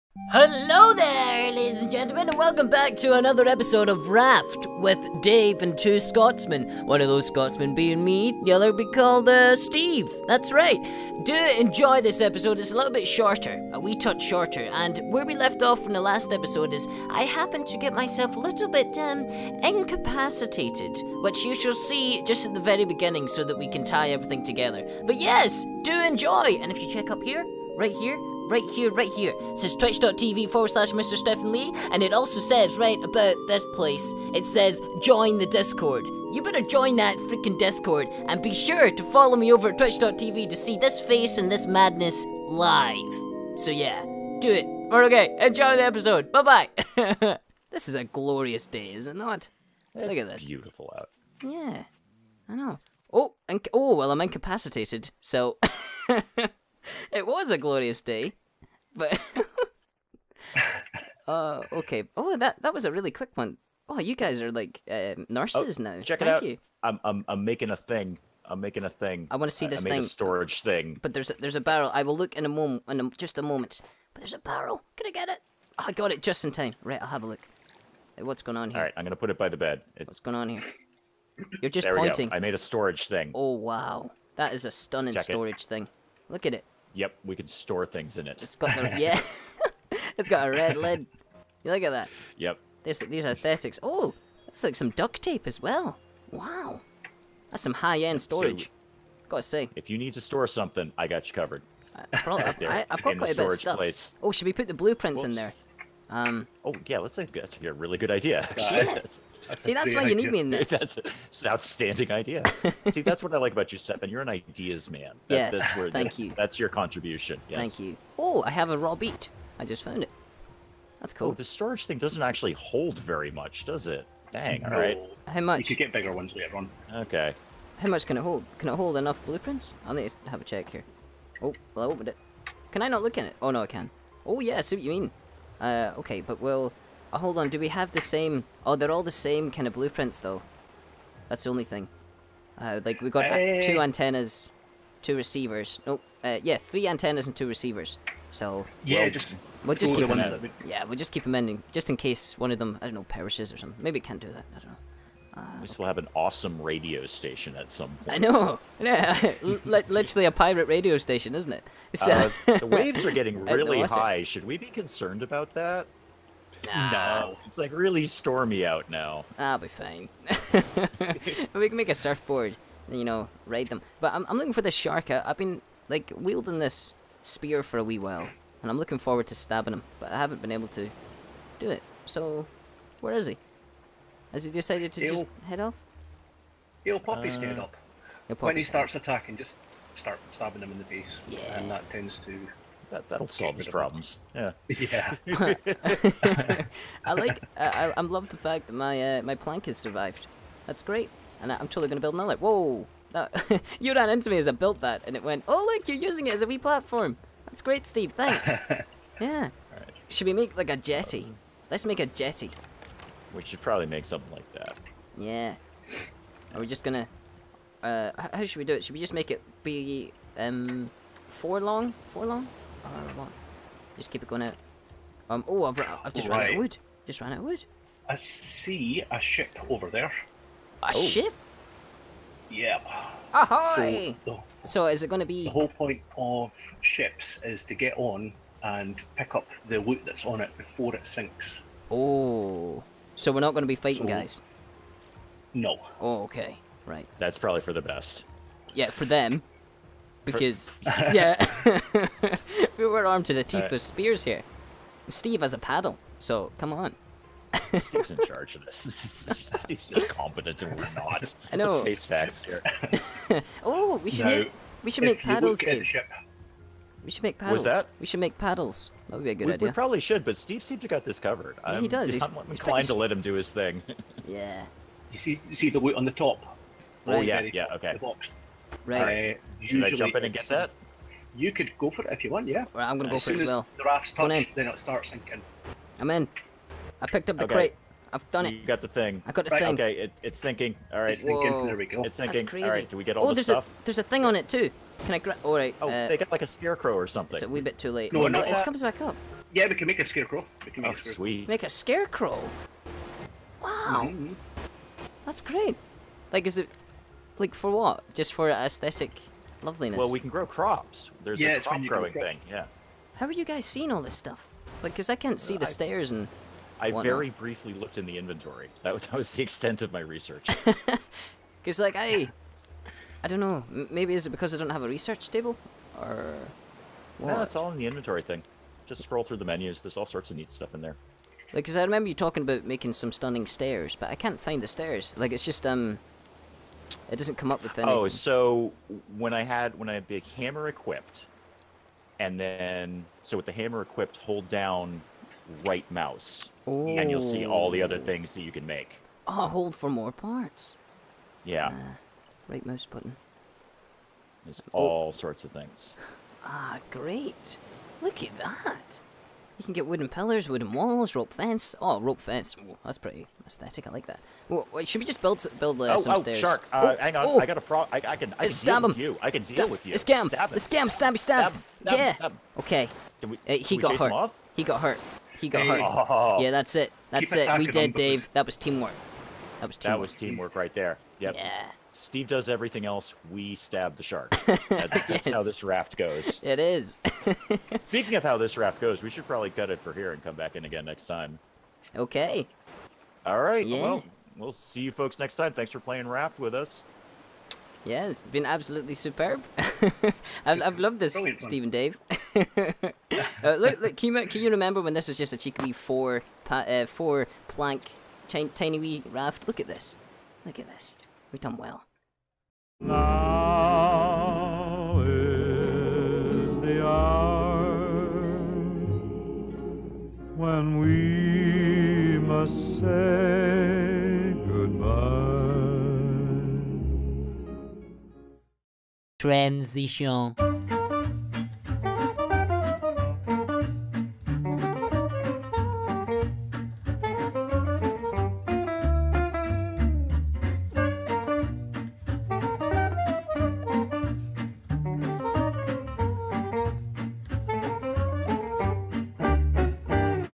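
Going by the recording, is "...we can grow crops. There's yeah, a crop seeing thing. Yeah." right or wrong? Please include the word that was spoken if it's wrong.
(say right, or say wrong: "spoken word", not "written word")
wrong: "growing", not "seeing".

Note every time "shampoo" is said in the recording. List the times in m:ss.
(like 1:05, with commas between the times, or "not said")
not said.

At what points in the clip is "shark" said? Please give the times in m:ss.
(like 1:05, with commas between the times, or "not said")
2:54, 6:06, 6:24.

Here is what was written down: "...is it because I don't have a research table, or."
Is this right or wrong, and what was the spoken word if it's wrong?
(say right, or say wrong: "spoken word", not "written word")
right.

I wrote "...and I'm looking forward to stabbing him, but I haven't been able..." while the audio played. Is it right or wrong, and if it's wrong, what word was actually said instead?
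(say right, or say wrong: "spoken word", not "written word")
right.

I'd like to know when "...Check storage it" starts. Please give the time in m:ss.
1:25.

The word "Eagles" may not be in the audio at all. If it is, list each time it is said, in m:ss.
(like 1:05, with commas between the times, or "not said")
not said.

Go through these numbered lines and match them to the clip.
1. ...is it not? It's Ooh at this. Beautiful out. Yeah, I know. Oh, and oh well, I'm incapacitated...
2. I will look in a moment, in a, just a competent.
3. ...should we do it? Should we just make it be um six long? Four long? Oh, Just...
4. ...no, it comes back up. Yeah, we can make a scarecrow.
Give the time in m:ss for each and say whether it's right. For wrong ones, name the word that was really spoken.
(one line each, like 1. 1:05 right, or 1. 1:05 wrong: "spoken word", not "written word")
1. 0:48 wrong: "Look", not "Ooh"
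2. 1:11 wrong: "moment", not "competent"
3. 3:38 wrong: "four", not "six"
4. 4:58 right.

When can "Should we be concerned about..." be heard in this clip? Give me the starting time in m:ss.
2:44.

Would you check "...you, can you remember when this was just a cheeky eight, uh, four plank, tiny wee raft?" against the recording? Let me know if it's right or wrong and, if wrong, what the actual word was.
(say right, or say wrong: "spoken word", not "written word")
wrong: "four", not "eight".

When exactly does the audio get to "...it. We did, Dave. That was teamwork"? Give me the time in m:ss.
6:17.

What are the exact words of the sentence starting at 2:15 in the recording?
Uh, okay, but we'll Oh, hold on, do we have the same...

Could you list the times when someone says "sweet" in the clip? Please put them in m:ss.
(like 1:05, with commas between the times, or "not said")
5:01.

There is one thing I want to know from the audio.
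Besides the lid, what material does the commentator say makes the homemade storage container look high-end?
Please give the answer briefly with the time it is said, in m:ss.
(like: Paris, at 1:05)
Duct tape, at 1:34.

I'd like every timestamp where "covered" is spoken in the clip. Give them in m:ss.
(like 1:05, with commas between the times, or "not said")
1:41, 4:31.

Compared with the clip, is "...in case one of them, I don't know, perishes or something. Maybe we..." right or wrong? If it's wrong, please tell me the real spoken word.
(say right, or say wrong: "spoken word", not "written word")
right.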